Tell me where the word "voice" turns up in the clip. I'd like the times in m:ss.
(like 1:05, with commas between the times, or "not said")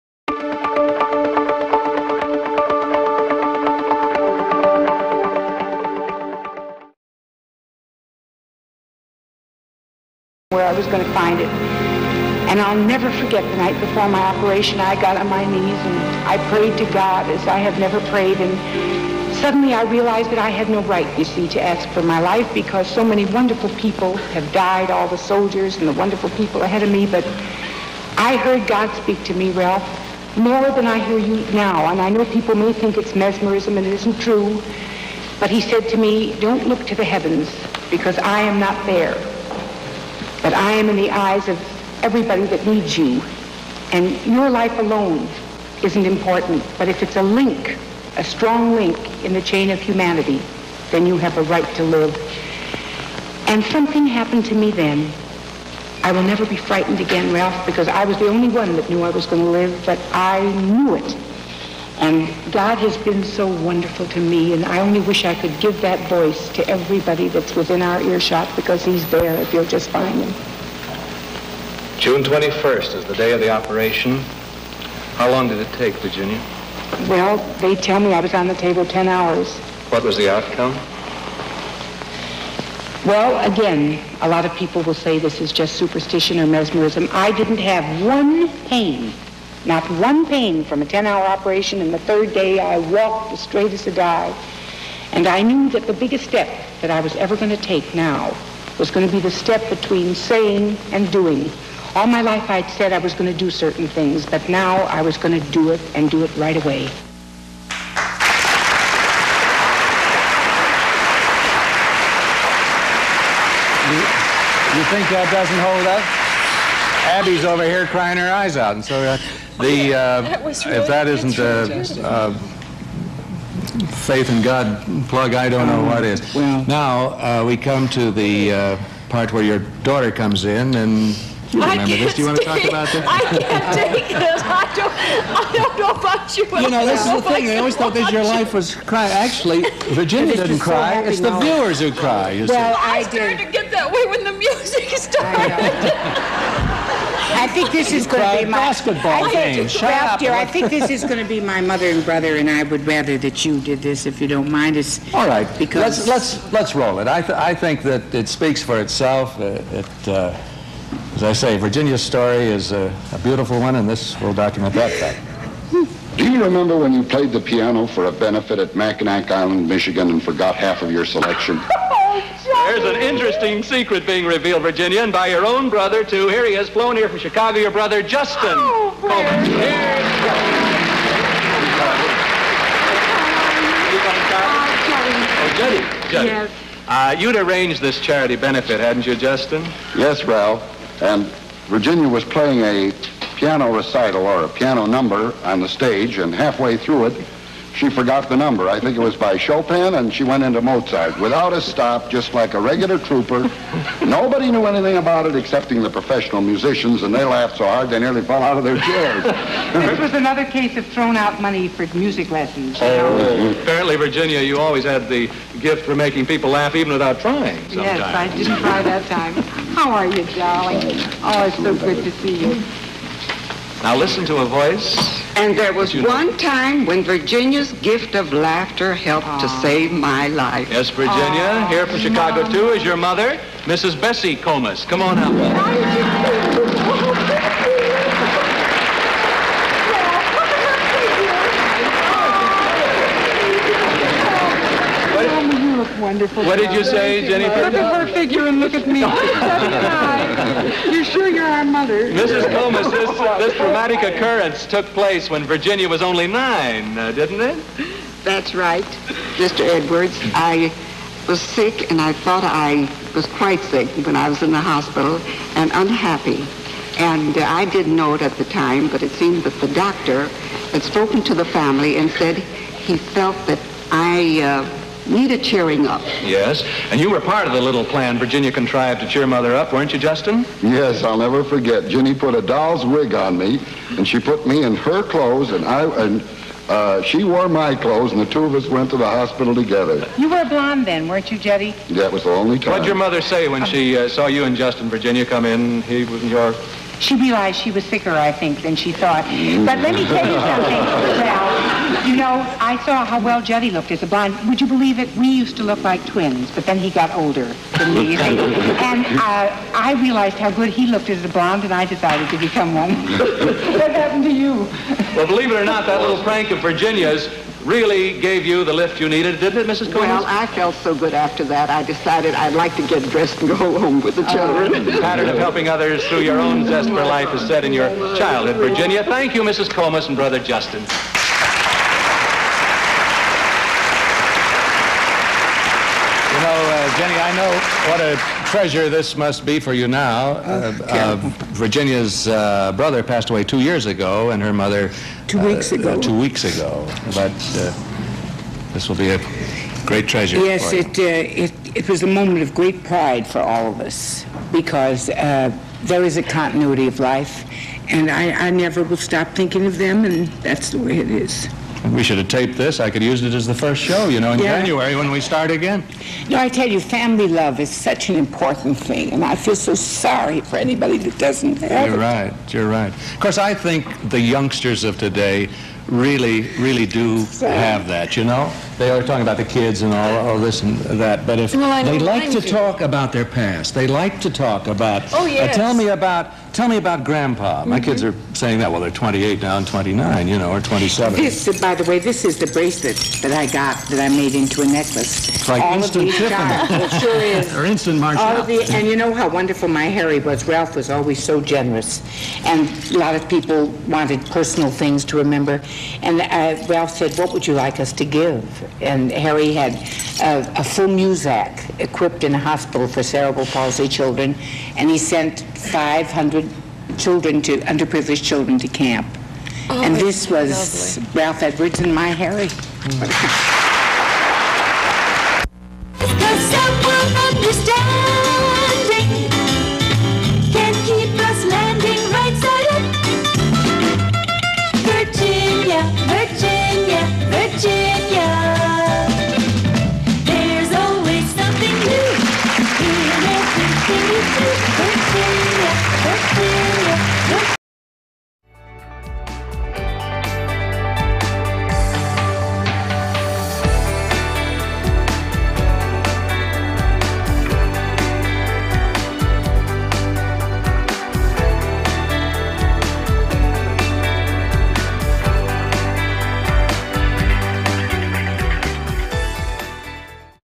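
1:06, 3:44.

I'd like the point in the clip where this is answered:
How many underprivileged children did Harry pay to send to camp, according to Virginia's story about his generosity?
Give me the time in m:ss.
6:55.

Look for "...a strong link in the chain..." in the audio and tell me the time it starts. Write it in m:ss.
0:48.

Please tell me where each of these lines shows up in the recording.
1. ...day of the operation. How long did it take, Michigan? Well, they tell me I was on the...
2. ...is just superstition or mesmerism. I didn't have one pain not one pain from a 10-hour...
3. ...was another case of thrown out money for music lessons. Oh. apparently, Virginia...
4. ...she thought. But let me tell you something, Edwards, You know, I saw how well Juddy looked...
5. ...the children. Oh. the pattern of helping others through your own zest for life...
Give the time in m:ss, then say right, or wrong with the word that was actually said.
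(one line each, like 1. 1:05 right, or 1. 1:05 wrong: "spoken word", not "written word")
1. 1:13 wrong: "Virginia", not "Michigan"
2. 1:25 right
3. 3:29 right
4. 4:58 wrong: "Well", not "Edwards"
5. 5:24 right.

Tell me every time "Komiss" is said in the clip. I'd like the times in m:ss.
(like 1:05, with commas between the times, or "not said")
3:54, 4:12, 5:19, 5:29.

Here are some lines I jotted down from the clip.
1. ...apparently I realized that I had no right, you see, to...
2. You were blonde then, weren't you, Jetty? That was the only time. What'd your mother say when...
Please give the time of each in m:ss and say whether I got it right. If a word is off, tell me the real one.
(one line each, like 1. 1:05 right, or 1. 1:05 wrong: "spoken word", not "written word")
1. 0:19 wrong: "suddenly", not "apparently"
2. 4:50 right.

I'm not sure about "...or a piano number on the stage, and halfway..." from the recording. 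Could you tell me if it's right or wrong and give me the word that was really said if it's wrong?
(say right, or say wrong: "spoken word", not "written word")
right.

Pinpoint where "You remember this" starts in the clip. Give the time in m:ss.
2:11.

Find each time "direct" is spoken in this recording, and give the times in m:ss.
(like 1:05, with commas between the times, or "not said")
not said.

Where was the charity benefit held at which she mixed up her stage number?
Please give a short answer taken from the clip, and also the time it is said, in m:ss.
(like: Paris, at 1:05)
Mackinac Island, Michigan, at 2:48.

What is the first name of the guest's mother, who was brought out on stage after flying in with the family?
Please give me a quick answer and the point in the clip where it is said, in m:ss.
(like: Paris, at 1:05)
Bessie, at 3:53.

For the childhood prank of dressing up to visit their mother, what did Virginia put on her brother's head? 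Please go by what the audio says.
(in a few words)
a doll's wig.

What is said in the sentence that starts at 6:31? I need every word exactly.
This, by the way, this is the bracelet that I got that I made into a necklace.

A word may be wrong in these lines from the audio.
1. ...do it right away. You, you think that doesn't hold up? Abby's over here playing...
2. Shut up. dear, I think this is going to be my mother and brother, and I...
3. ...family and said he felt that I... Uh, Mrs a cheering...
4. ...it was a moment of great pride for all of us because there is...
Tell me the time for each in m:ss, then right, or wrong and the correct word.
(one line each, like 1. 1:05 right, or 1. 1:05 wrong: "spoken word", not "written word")
1. 1:46 wrong: "crying", not "playing"
2. 2:29 right
3. 4:31 wrong: "Need", not "Mrs"
4. 5:51 right.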